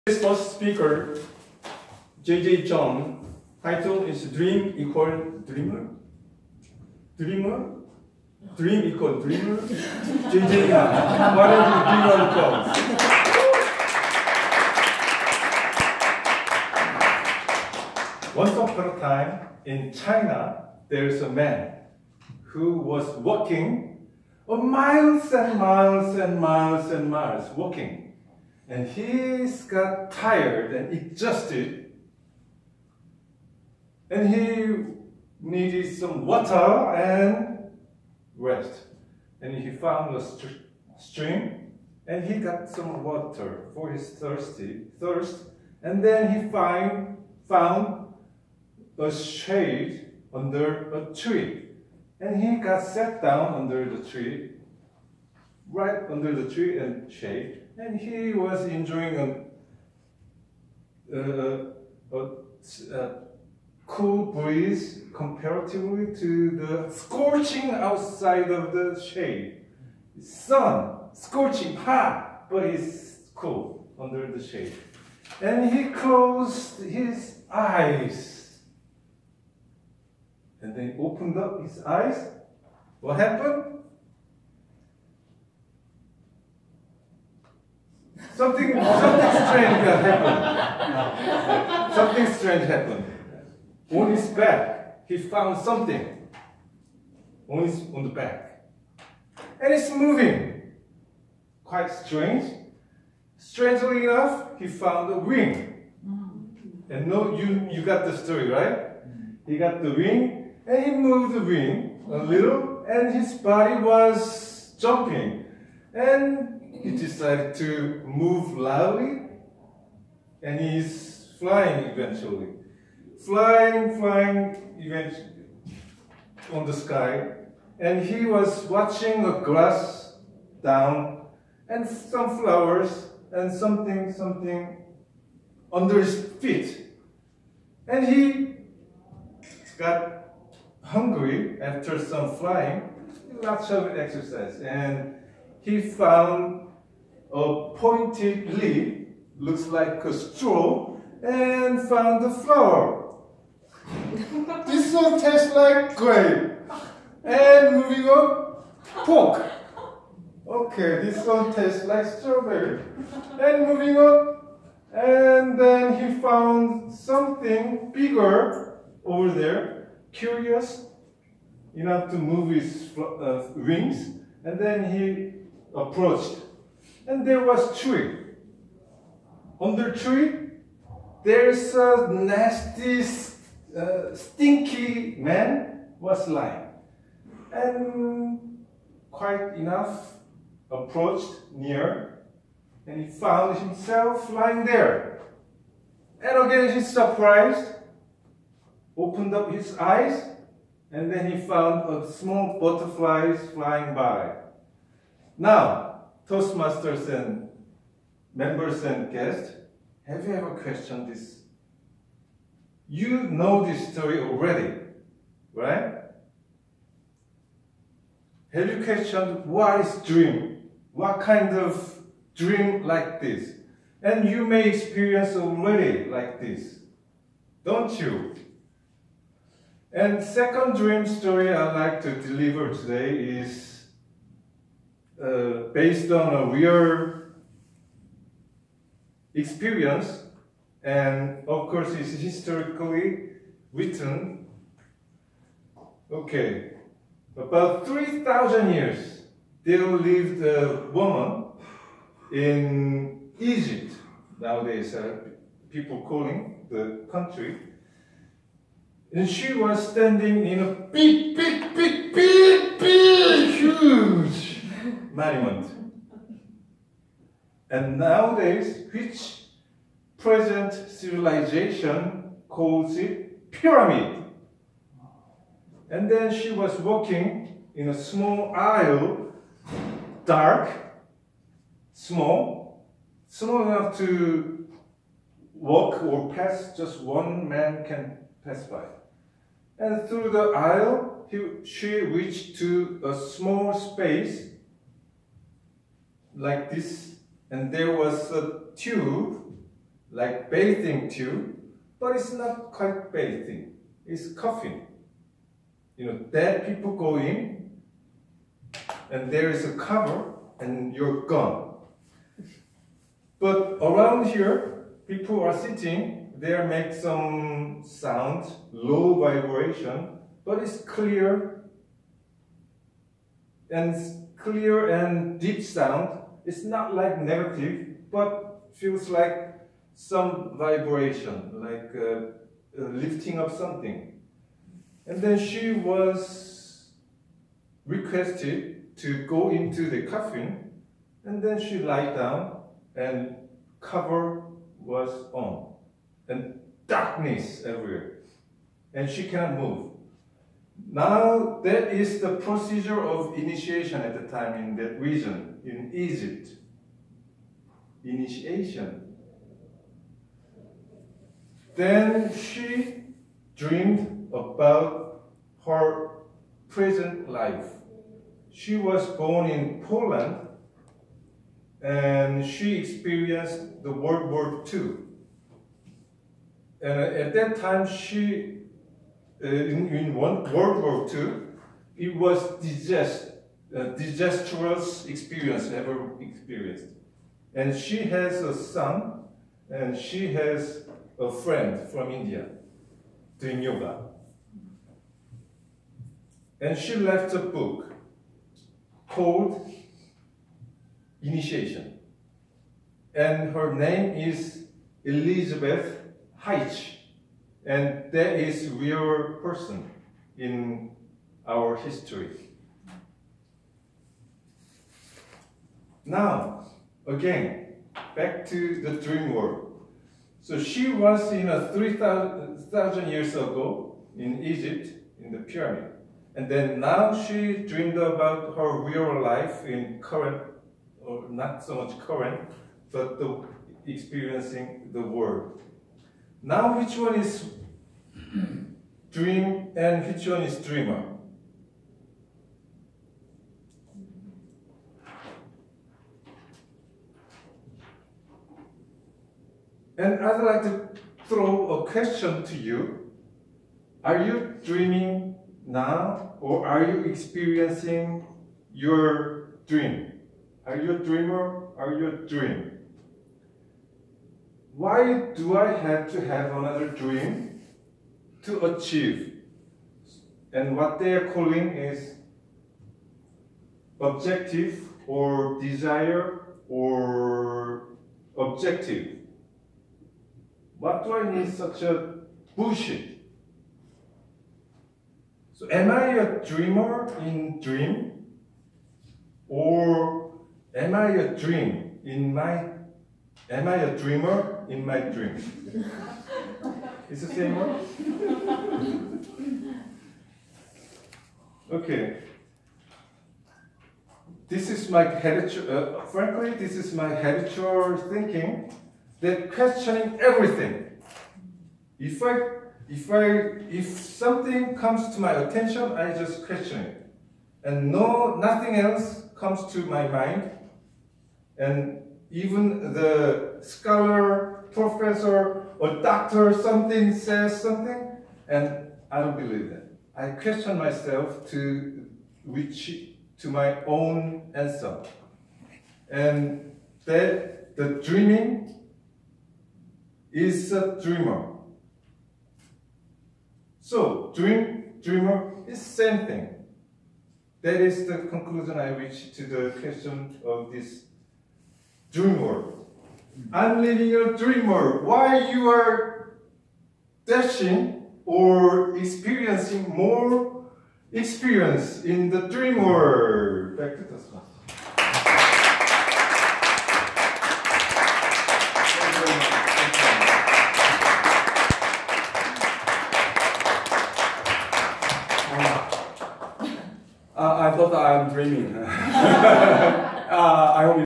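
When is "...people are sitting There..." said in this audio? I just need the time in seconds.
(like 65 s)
315 s.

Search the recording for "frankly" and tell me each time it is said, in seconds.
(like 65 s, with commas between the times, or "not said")
506 s.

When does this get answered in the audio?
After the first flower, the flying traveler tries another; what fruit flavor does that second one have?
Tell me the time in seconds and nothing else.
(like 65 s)
162 s.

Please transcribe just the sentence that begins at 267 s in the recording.
And nowadays, which present civilization calls it pyramid.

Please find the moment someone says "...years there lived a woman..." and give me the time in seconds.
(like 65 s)
248 s.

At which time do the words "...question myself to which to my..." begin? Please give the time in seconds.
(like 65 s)
530 s.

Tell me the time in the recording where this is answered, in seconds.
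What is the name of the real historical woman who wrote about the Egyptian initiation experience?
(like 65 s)
405 s.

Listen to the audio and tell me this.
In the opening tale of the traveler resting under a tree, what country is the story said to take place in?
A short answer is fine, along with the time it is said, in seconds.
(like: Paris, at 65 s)
China, at 19 s.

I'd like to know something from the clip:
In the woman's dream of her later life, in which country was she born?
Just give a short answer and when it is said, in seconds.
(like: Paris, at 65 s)
Poland, at 369 s.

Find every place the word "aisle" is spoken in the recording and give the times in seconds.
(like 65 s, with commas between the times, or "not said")
278 s, 290 s.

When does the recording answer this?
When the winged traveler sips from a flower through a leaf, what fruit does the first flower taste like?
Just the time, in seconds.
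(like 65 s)
155 s.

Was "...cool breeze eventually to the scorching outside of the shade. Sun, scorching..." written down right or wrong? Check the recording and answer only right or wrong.
wrong.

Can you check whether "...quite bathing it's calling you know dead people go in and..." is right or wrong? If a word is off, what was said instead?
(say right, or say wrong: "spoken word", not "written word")
wrong: "coughing", not "calling".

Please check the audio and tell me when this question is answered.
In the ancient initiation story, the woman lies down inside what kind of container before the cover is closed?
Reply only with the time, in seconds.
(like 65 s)
340 s.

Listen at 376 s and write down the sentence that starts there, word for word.
And uh, at that time, she, uh, in, in one, World War II, it was disaster, disastrous experience ever experienced.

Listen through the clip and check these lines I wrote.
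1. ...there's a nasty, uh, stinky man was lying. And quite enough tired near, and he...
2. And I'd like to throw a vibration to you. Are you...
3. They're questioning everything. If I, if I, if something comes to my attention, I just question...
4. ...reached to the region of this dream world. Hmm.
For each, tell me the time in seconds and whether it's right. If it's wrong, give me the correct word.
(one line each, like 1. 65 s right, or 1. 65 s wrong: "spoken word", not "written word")
1. 181 s wrong: "approached", not "tired"
2. 450 s wrong: "question", not "vibration"
3. 509 s right
4. 548 s wrong: "question", not "region".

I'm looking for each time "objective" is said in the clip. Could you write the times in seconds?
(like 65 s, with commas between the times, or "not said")
473 s, 478 s.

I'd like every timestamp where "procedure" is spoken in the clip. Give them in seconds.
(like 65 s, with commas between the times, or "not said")
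352 s.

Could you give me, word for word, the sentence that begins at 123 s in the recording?
Flying, flying eventually on the sky.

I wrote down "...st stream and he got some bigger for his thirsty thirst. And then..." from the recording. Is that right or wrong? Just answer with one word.
wrong.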